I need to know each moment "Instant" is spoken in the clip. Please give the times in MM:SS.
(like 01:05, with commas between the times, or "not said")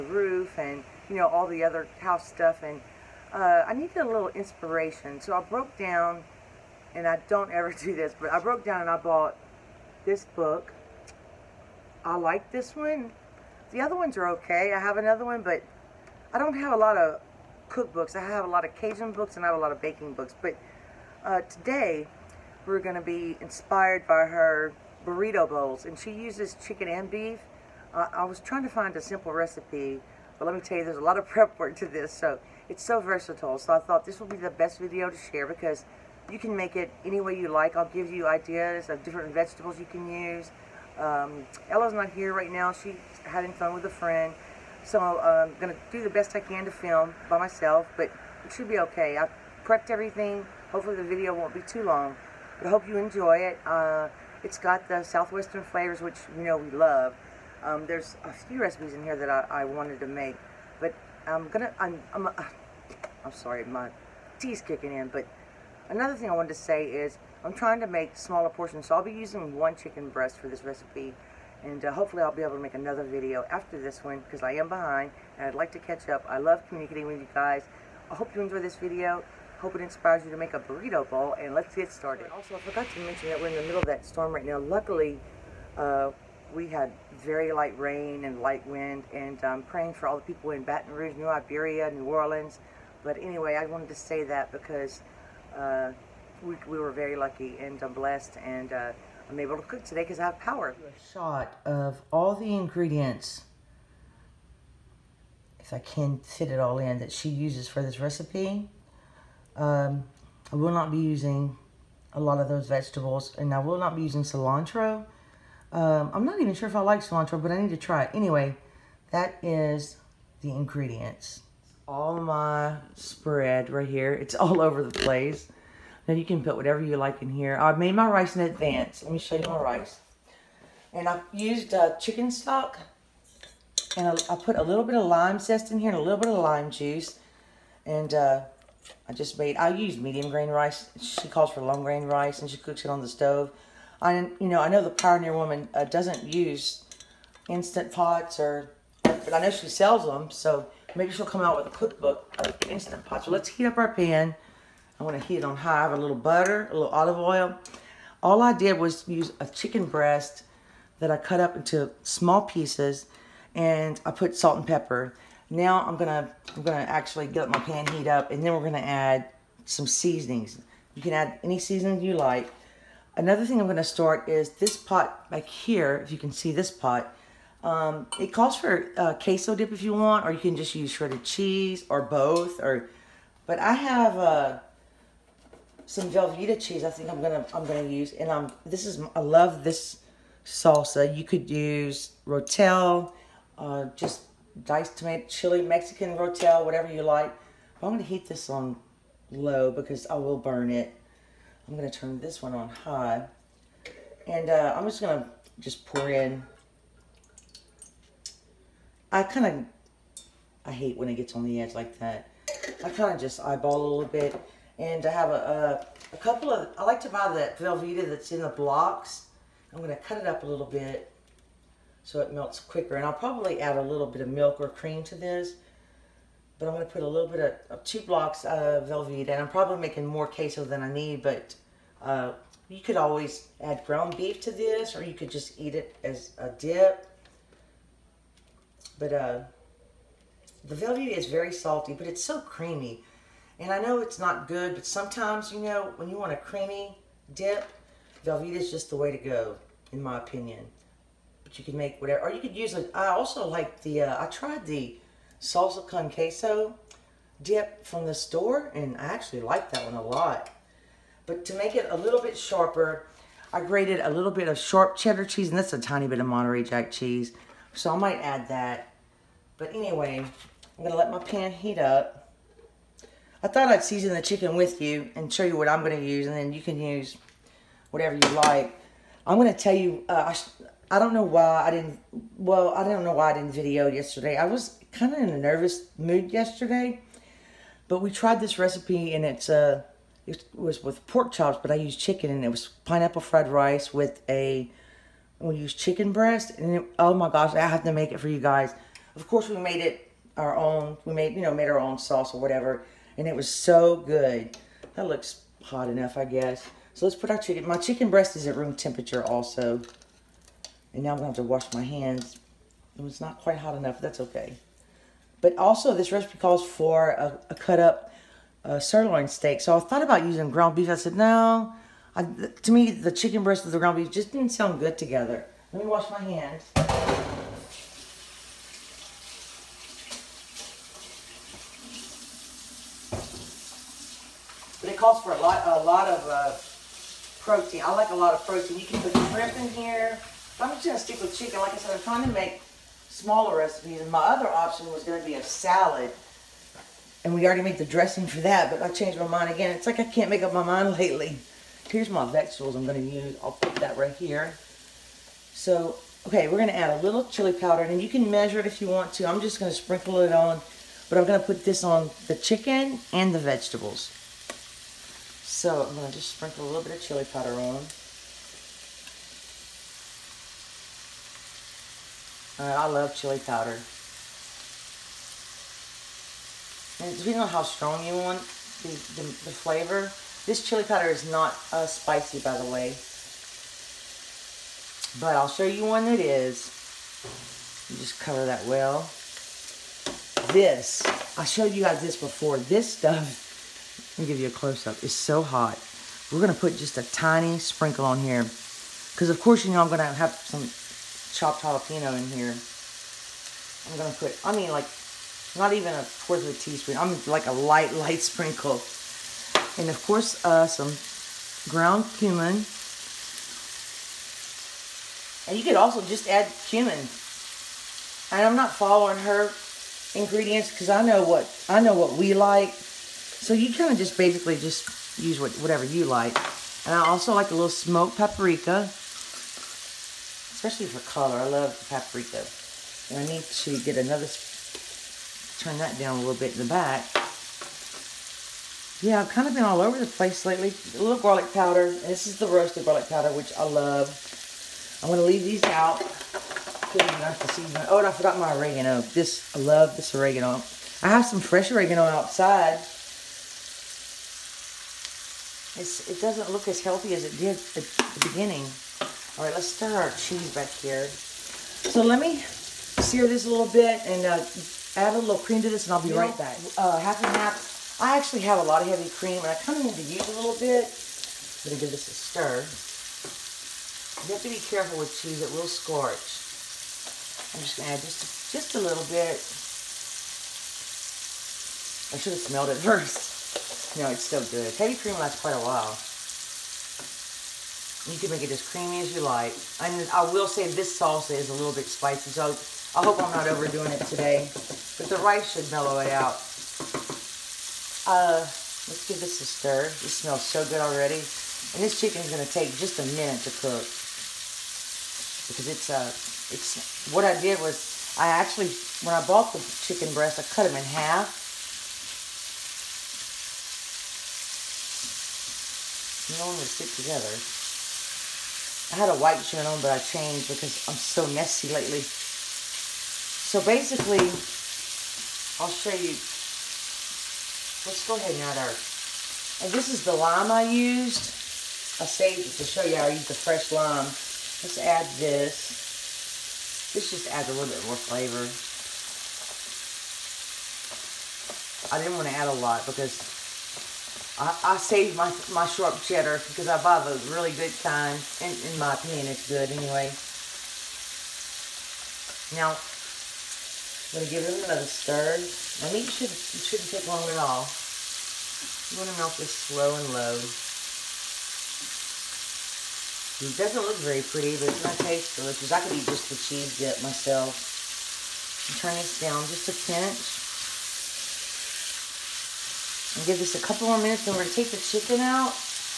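02:27, 02:32.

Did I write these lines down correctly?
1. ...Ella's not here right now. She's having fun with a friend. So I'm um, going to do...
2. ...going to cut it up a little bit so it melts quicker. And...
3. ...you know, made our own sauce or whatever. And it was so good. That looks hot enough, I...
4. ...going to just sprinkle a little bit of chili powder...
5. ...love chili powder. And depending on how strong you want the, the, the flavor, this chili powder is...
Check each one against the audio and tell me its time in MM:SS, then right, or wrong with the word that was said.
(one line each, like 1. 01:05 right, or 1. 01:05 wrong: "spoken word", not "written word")
1. 00:41 right
2. 03:39 right
3. 05:01 right
4. 06:05 right
5. 06:12 right.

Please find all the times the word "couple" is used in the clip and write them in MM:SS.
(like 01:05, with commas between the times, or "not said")
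03:36, 09:33.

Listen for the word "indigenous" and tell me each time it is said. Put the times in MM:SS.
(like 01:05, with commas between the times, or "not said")
not said.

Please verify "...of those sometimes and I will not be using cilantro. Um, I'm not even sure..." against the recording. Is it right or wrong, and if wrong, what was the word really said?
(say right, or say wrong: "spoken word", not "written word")
wrong: "vegetables", not "sometimes".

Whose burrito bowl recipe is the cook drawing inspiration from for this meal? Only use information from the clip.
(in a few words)
The Pioneer Woman.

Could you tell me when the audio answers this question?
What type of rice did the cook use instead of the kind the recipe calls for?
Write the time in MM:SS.
02:20.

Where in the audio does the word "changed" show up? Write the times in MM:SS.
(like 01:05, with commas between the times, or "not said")
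05:48, 08:39.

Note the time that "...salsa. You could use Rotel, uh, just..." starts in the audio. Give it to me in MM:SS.
03:10.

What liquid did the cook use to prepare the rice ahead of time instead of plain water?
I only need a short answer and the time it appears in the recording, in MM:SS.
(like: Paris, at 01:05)
Chicken stock, at 02:11.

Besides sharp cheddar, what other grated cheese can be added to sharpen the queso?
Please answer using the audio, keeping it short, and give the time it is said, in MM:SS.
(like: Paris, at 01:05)
Monterey Jack, at 04:26.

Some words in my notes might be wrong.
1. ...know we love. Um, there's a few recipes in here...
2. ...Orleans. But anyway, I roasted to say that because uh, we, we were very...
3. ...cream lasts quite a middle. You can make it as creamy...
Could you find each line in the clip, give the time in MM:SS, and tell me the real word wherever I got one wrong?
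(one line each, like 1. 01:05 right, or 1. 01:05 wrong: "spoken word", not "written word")
1. 00:56 right
2. 01:32 wrong: "wanted", not "roasted"
3. 08:04 wrong: "while", not "middle".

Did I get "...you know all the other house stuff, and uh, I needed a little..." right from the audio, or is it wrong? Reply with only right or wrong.
right.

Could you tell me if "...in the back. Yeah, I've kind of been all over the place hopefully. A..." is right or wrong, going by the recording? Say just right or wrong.
wrong.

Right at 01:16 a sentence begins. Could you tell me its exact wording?
I love communicating with you guys.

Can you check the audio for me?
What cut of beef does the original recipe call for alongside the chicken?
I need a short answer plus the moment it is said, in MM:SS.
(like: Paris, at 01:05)
Sirloin steak, at 05:18.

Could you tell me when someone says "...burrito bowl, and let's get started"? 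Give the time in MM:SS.
01:20.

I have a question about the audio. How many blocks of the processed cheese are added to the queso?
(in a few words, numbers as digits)
2.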